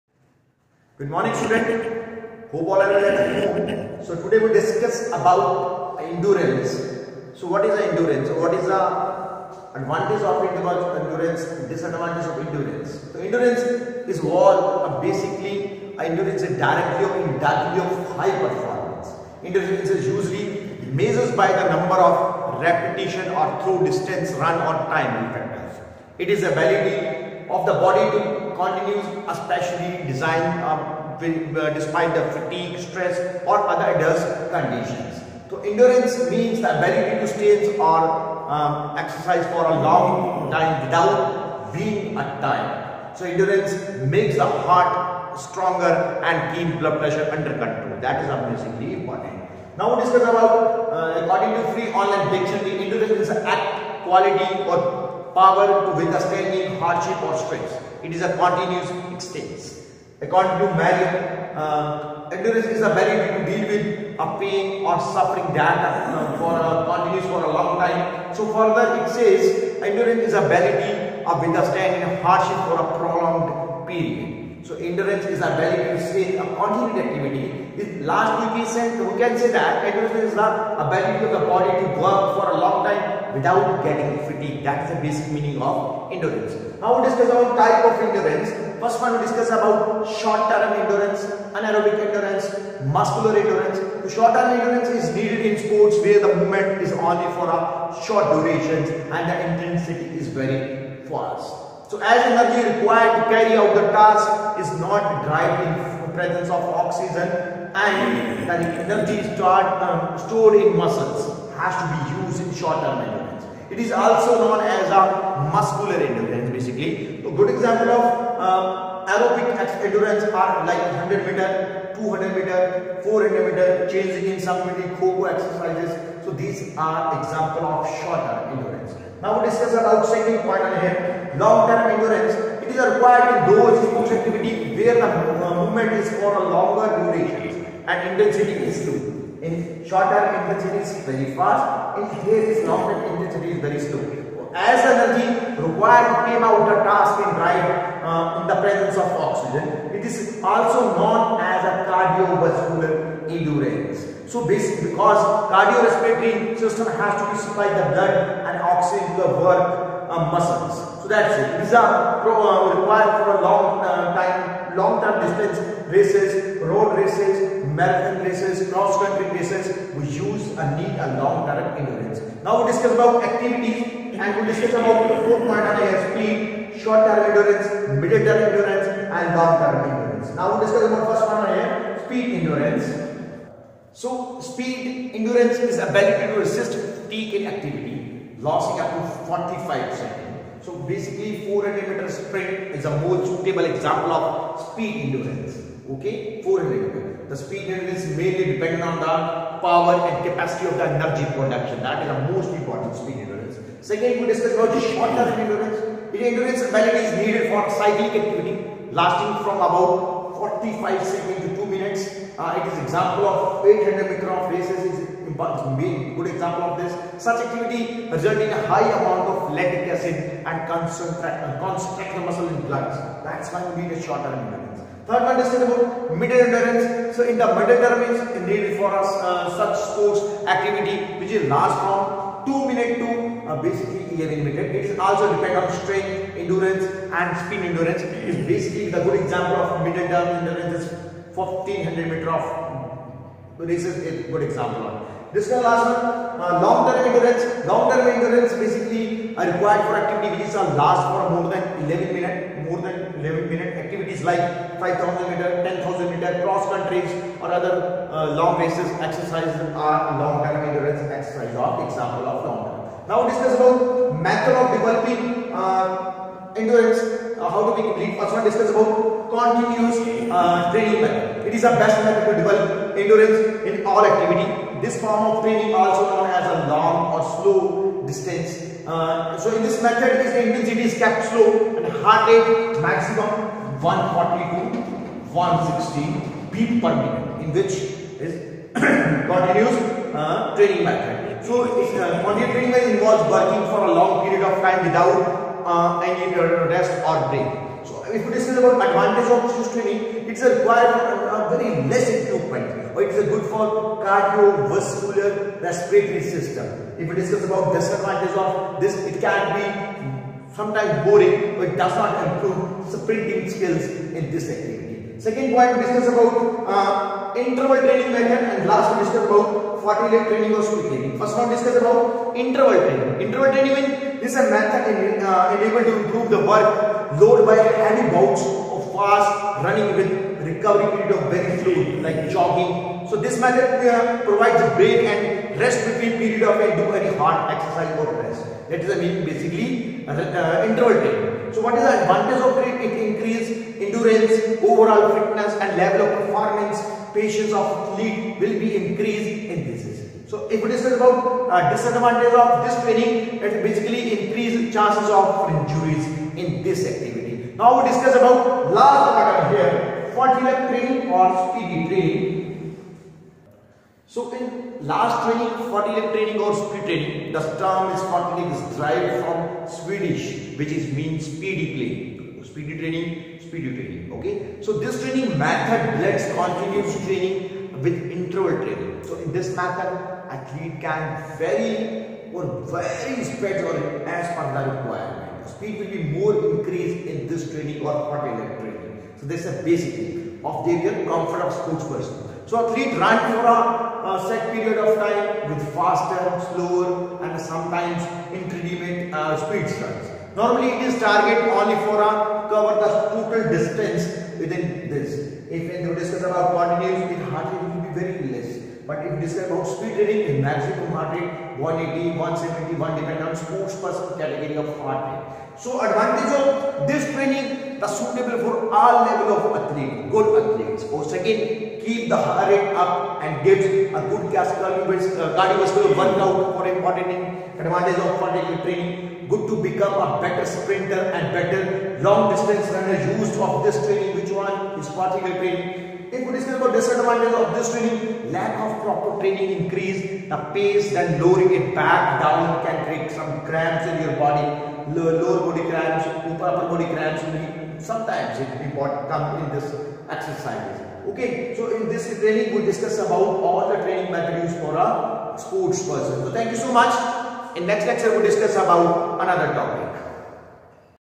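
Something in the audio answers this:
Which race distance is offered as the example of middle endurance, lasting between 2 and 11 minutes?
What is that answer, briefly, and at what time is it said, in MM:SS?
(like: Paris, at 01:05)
1500 meter, at 04:01.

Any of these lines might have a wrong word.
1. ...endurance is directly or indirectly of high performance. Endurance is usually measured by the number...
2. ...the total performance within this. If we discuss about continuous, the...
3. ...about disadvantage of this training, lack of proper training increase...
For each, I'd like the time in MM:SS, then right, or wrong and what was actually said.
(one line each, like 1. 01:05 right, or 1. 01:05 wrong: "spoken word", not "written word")
1. 00:15 right
2. 06:42 wrong: "distance", not "performance"
3. 07:16 right.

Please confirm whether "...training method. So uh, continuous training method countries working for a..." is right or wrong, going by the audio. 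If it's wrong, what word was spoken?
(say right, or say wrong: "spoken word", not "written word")
wrong: "involves", not "countries".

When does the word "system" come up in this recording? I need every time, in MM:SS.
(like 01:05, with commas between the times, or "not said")
02:36, 05:06.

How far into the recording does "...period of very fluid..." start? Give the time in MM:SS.
05:30.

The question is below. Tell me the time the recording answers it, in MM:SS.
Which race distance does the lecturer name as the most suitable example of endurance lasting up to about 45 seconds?
03:11.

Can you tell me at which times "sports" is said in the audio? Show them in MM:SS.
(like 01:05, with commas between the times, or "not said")
01:35, 02:13, 03:49, 06:53, 07:35.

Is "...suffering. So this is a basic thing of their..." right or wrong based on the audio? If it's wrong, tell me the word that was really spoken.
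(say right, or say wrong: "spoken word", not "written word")
wrong: "training", not "suffering".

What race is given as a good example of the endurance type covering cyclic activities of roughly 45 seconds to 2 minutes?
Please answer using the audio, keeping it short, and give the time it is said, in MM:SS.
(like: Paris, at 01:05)
800 meter, at 03:33.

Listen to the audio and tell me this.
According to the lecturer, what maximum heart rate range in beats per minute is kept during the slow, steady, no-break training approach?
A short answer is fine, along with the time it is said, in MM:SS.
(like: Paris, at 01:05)
140 to 160, at 04:43.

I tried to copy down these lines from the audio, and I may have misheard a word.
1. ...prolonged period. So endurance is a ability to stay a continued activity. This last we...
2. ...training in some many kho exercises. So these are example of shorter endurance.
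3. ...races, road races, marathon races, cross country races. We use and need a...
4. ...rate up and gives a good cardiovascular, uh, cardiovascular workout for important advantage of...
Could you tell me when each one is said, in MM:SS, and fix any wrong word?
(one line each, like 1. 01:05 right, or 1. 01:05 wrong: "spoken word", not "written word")
1. 01:12 right
2. 02:03 wrong: "changing", not "training"
3. 02:45 right
4. 07:02 right.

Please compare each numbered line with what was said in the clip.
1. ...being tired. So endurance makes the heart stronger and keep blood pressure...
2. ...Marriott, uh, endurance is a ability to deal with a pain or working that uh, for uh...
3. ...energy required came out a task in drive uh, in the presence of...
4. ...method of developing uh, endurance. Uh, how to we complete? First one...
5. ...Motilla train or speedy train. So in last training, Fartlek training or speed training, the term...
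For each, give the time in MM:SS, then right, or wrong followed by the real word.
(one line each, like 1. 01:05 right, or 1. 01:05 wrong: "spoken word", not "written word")
1. 00:41 right
2. 01:00 wrong: "suffering", not "working"
3. 02:24 right
4. 04:24 right
5. 06:00 right.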